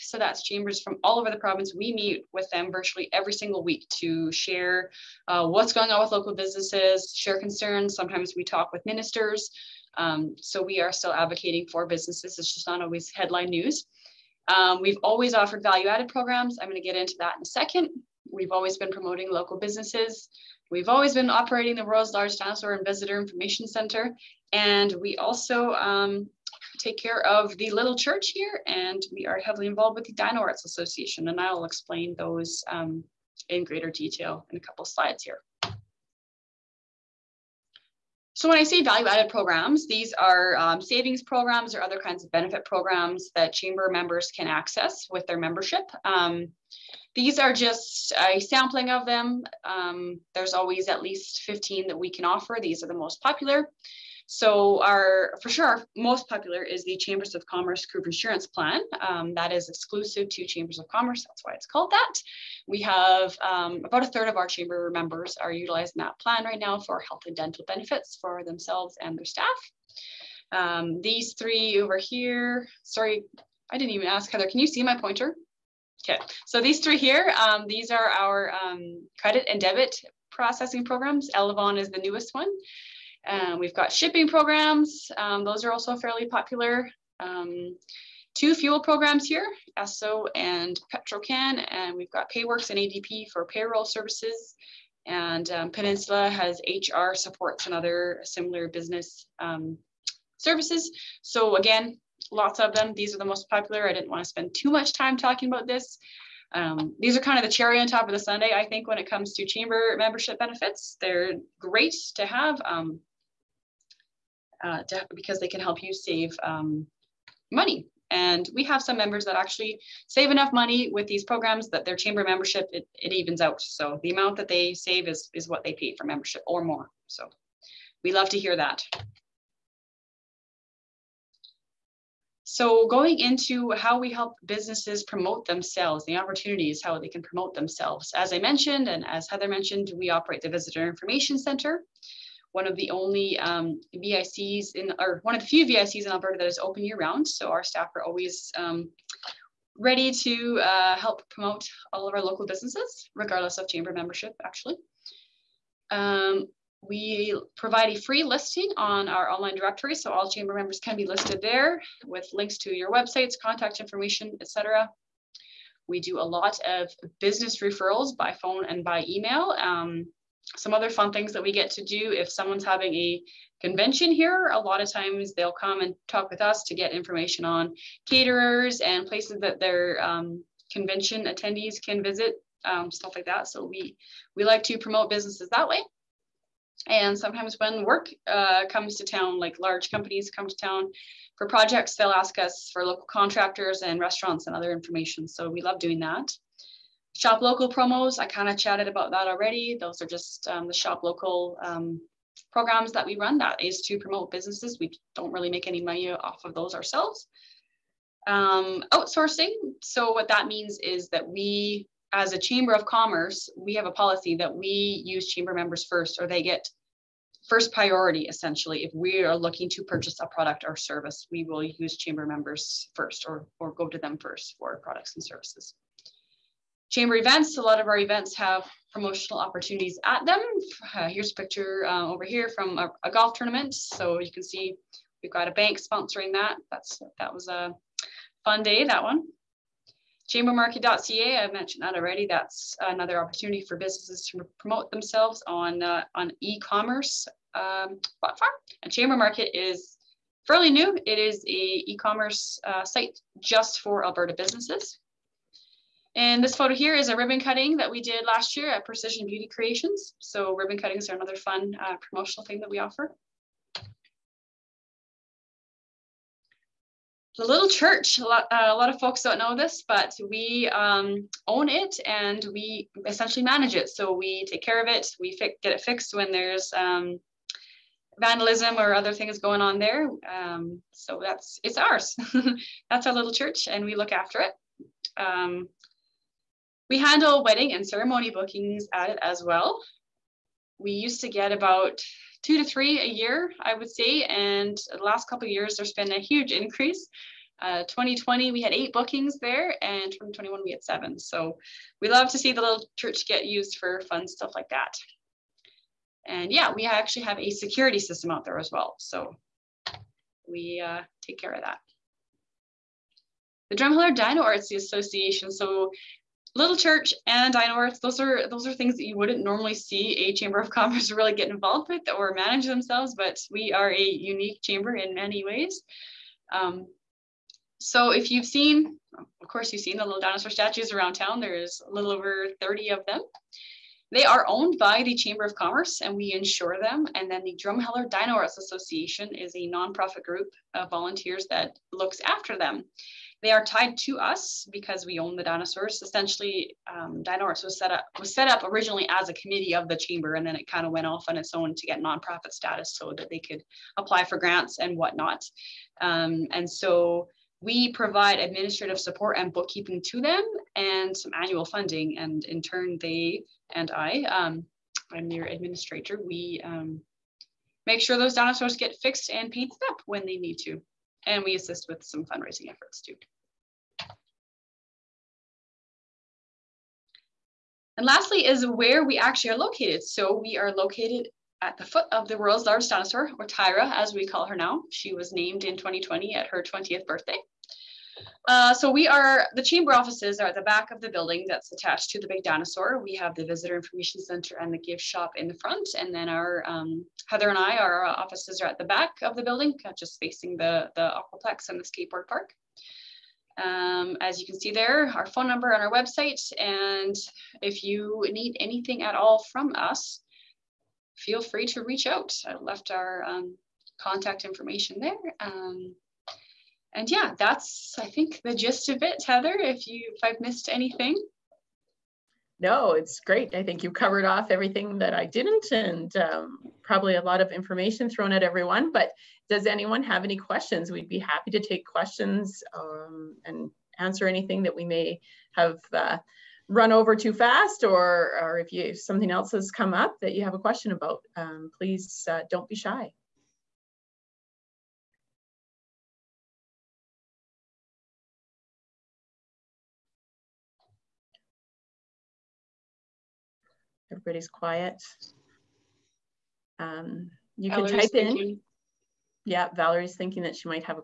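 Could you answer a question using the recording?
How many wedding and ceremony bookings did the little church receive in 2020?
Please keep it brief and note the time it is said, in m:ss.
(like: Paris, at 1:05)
8, at 4:58.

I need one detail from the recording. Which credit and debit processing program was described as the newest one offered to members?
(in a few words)
Elavon.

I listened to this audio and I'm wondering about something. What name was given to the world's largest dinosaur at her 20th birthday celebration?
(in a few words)
Tyra.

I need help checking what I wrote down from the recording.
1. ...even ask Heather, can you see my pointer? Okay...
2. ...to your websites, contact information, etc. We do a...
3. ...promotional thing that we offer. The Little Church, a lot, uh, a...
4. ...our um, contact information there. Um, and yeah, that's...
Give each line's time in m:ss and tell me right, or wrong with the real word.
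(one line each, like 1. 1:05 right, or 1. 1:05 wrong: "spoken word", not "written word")
1. 1:13 right
2. 2:42 right
3. 4:21 right
4. 6:52 right.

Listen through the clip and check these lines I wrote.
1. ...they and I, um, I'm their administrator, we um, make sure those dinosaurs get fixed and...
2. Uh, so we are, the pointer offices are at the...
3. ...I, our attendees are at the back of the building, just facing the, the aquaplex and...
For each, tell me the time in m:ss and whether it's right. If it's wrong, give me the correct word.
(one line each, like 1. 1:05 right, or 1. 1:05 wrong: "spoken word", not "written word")
1. 6:02 right
2. 6:28 wrong: "chamber", not "pointer"
3. 6:37 wrong: "offices", not "attendees".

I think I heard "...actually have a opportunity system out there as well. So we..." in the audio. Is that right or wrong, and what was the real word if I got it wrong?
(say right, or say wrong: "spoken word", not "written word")
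wrong: "security", not "opportunity".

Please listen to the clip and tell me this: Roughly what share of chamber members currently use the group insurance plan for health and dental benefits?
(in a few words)
a third.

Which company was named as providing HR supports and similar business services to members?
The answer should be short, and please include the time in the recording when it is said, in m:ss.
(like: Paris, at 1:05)
Peninsula, at 1:35.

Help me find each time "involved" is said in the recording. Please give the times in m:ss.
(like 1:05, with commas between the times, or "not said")
0:29, 5:21.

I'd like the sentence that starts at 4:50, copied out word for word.
We used to get about two to three a year, I would say.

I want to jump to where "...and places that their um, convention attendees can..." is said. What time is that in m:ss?
2:58.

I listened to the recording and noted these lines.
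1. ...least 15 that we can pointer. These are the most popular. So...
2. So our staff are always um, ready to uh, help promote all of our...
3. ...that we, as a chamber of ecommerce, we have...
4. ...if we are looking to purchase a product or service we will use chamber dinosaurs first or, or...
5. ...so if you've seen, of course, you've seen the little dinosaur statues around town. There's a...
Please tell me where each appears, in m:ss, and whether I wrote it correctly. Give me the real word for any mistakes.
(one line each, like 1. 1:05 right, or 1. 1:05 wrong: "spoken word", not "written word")
1. 0:51 wrong: "offer", not "pointer"
2. 2:27 right
3. 3:31 wrong: "commerce", not "ecommerce"
4. 3:38 wrong: "members", not "dinosaurs"
5. 5:27 right.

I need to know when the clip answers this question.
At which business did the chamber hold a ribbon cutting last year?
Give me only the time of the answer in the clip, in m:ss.
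4:18.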